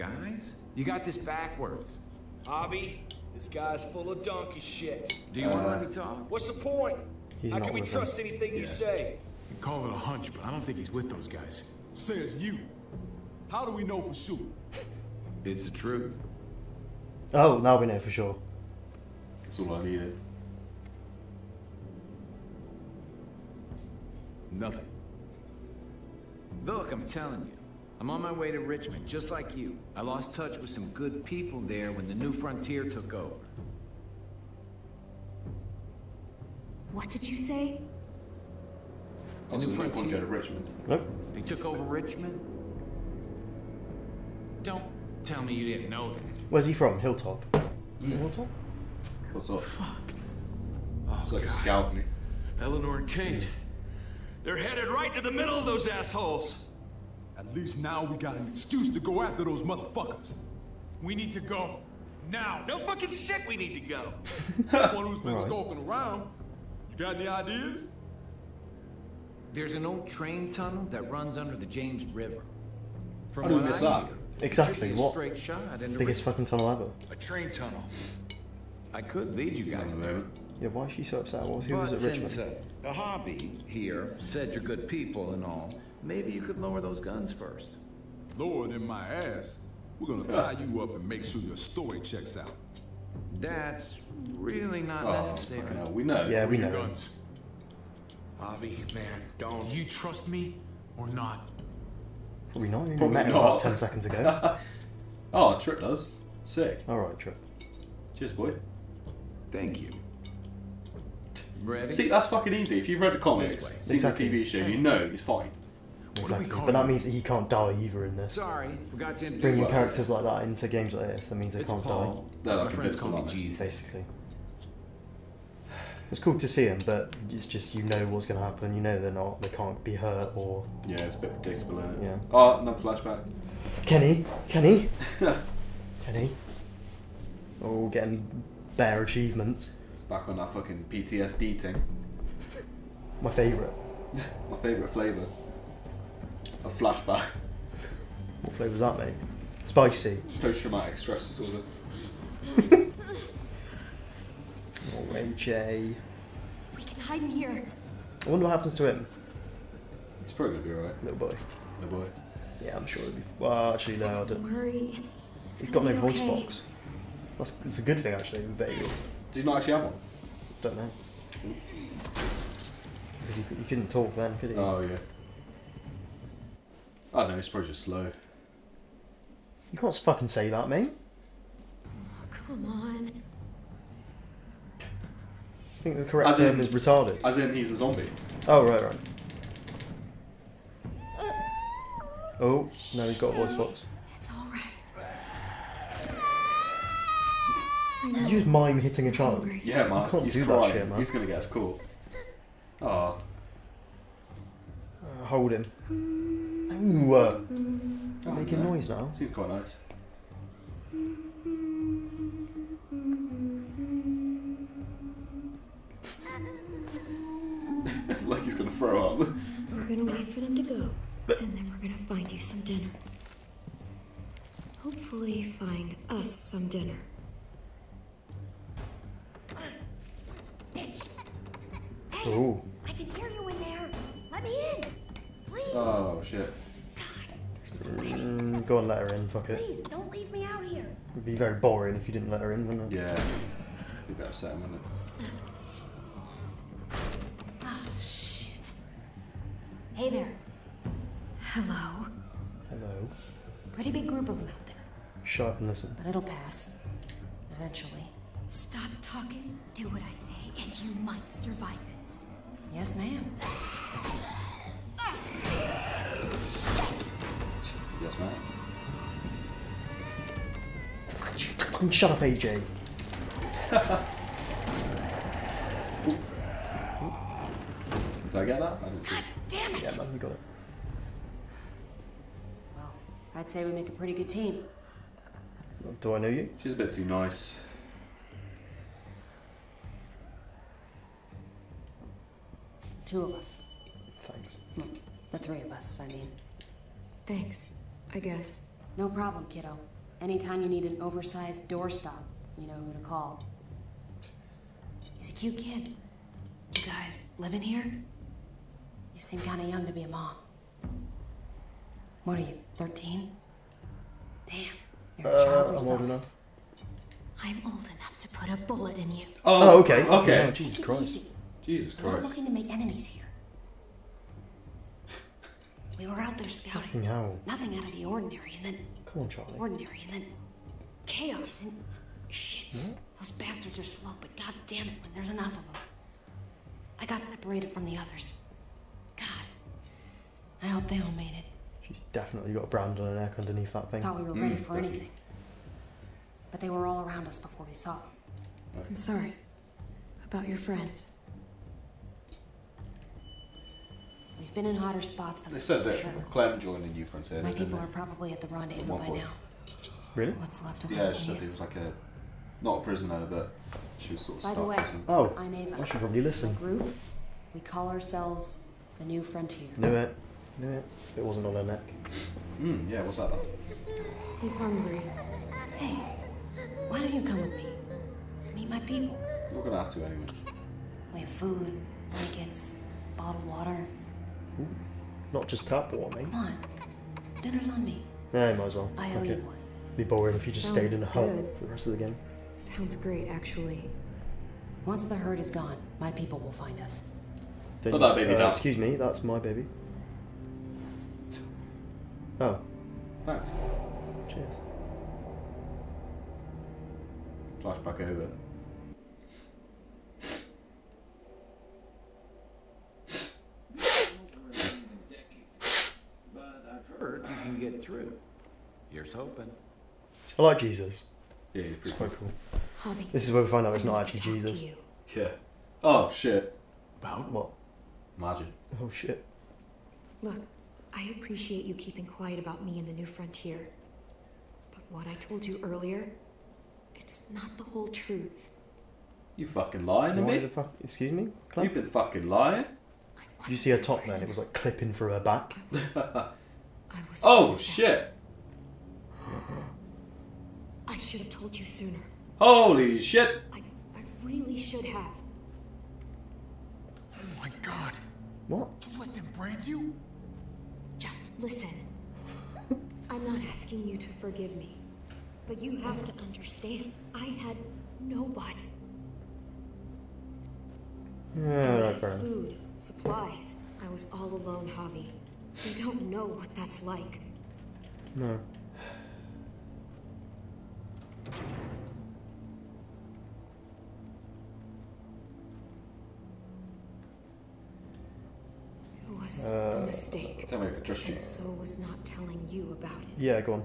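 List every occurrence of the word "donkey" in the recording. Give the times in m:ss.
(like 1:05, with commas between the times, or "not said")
0:04.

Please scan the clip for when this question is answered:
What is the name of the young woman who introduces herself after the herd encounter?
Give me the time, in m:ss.
6:05.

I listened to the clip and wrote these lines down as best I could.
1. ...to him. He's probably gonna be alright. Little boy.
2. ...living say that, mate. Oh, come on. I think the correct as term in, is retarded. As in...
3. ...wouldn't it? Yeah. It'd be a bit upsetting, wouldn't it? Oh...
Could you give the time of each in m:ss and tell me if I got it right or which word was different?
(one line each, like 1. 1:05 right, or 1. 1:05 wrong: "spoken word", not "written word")
1. 2:38 right
2. 2:59 wrong: "fucking", not "living"
3. 4:02 right.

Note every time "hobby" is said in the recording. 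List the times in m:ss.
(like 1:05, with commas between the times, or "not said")
1:22.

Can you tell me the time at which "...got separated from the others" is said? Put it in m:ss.
5:37.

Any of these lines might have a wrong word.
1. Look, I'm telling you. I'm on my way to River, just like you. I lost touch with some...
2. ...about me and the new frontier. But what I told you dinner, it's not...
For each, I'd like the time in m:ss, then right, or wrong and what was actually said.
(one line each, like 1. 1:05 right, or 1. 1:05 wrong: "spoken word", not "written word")
1. 0:26 wrong: "Richmond", not "River"
2. 7:12 wrong: "earlier", not "dinner".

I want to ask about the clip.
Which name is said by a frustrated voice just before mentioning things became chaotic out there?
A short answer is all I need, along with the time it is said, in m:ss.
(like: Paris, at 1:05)
Charlie, at 5:29.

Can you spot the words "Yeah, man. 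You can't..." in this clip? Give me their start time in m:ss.
3:19.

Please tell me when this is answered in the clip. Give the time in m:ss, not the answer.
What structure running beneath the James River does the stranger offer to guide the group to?
1:09.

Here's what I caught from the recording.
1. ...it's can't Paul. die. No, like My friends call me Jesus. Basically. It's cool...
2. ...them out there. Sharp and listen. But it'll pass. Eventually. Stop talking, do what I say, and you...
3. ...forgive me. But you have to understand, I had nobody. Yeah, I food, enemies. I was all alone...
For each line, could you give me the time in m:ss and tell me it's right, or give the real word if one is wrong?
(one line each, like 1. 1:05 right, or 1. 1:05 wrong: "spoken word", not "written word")
1. 2:01 right
2. 4:14 right
3. 7:44 wrong: "supplies", not "enemies".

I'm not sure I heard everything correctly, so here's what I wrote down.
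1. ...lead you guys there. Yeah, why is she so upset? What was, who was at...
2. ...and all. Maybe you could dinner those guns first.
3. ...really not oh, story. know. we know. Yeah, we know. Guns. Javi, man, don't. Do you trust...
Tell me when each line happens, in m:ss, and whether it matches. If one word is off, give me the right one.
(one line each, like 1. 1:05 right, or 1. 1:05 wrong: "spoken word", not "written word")
1. 1:19 right
2. 1:25 wrong: "lower", not "dinner"
3. 1:34 wrong: "necessary", not "story".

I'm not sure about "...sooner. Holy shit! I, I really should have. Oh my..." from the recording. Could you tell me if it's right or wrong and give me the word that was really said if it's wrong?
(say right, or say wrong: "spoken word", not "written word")
right.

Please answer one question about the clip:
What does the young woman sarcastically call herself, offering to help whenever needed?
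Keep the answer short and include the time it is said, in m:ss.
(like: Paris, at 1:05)
An oversized doorstop, at 5:01.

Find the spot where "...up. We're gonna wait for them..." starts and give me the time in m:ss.
3:39.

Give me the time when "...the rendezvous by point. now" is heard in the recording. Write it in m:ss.
5:58.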